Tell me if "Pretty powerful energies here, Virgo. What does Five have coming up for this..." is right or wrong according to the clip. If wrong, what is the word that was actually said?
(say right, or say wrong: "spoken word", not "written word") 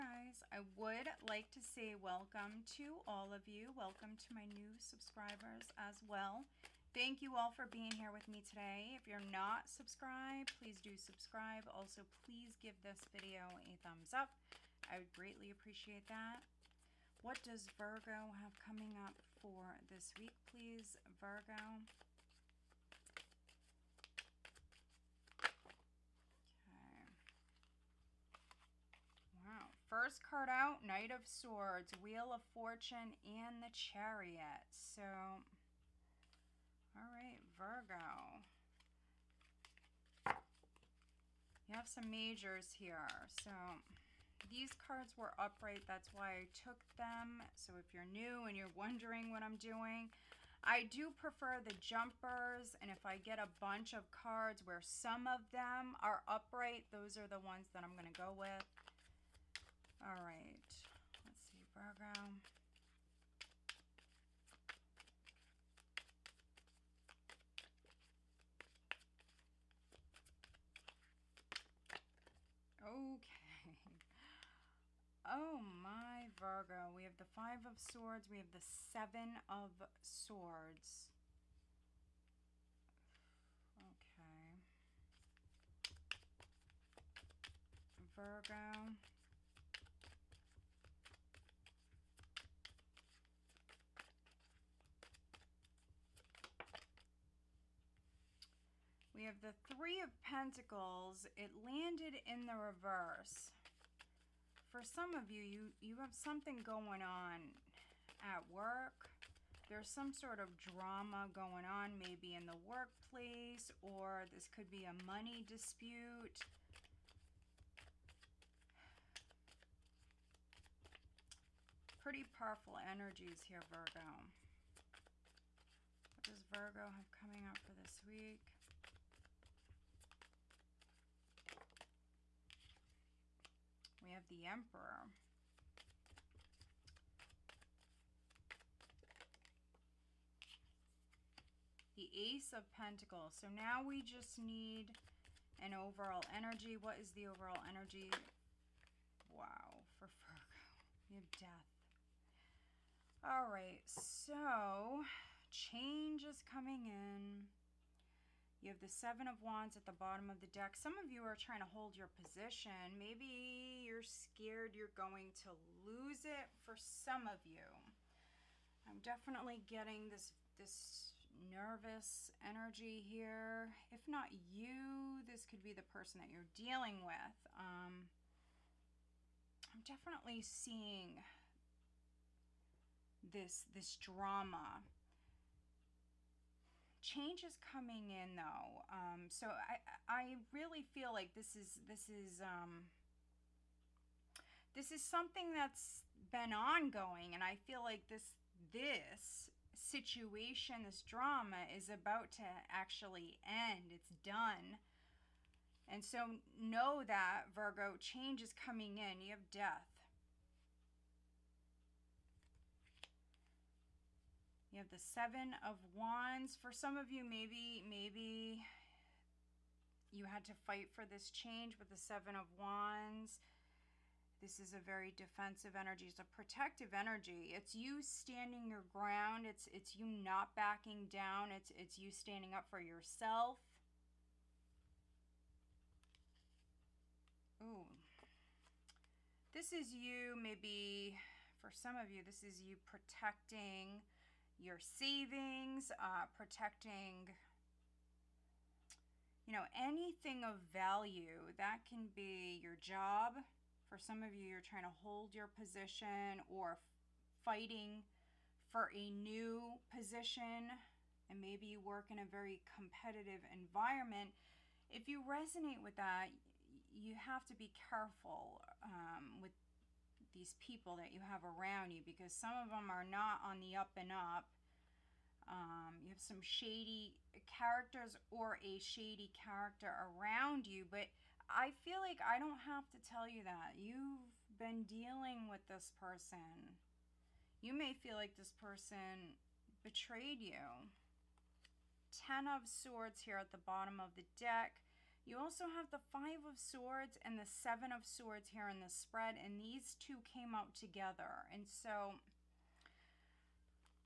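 wrong: "Virgo", not "Five".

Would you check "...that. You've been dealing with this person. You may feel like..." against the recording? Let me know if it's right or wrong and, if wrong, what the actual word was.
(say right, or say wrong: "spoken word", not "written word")
right.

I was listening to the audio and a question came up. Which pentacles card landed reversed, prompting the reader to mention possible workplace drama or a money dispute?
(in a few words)
Three of Pentacles.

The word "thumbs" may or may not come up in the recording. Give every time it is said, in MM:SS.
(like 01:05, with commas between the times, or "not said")
00:13.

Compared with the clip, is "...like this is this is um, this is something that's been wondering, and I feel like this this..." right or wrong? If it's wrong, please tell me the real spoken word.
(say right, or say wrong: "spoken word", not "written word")
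wrong: "ongoing", not "wondering".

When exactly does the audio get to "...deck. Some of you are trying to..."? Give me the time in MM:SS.
02:40.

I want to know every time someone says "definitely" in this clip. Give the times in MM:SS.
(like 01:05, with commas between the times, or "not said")
02:49, 02:59.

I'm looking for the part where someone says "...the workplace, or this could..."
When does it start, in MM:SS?
01:52.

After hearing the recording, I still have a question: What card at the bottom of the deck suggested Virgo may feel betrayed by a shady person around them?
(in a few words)
Ten of Swords.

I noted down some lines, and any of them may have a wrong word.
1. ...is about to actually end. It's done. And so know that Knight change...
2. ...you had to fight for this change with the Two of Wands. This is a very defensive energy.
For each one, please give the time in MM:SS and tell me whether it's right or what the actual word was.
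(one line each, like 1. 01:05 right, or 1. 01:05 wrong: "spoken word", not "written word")
1. 03:21 wrong: "Virgo", not "Knight"
2. 03:40 wrong: "Seven", not "Two".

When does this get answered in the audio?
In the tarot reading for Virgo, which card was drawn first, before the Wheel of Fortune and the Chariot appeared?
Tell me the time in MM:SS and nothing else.
00:30.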